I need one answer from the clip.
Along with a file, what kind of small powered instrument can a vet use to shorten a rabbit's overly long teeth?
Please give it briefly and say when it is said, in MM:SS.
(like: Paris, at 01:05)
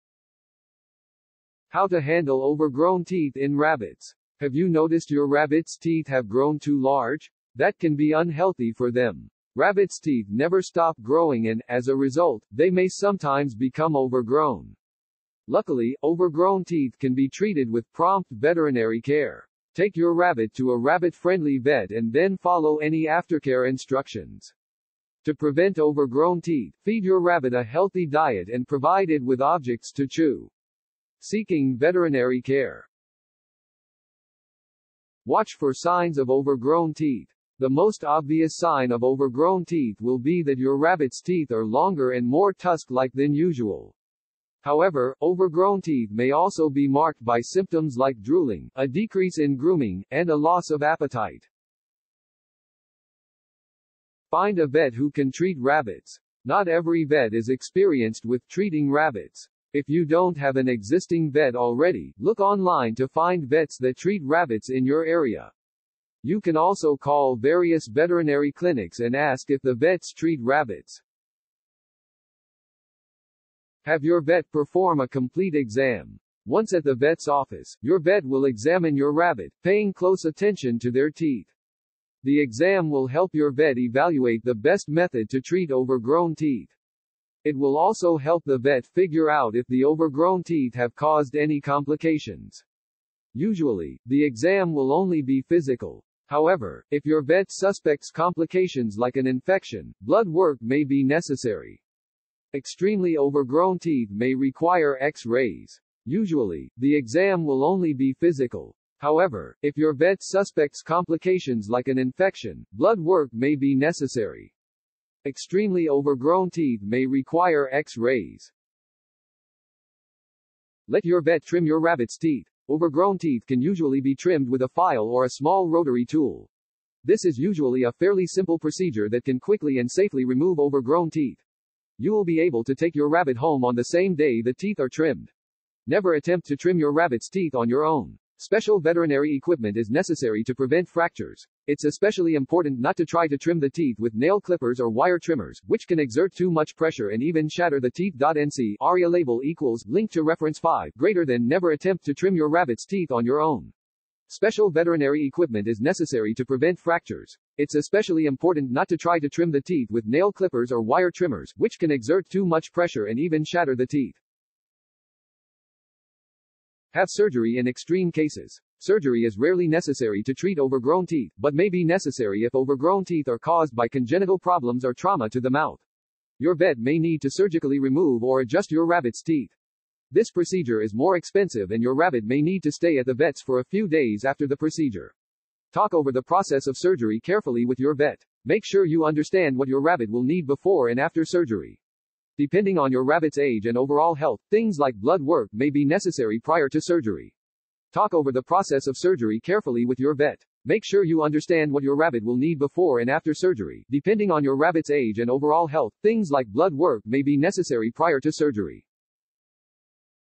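Small rotary tool, at 02:05.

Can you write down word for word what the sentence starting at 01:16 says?
Once at the vet's office, your vet will examine your rabbit, paying close attention to their teeth.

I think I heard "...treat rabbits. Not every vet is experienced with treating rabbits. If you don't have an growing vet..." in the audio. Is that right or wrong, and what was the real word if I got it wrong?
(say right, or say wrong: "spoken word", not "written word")
wrong: "existing", not "growing".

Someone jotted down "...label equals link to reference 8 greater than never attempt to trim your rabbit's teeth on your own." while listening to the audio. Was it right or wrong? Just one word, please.
wrong.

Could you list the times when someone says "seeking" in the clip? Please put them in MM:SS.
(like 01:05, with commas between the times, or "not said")
00:31.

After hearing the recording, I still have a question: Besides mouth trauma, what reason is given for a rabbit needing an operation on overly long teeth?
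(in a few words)
Congenital problems.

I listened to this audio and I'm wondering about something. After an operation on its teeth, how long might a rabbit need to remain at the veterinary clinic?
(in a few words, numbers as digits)
A few days.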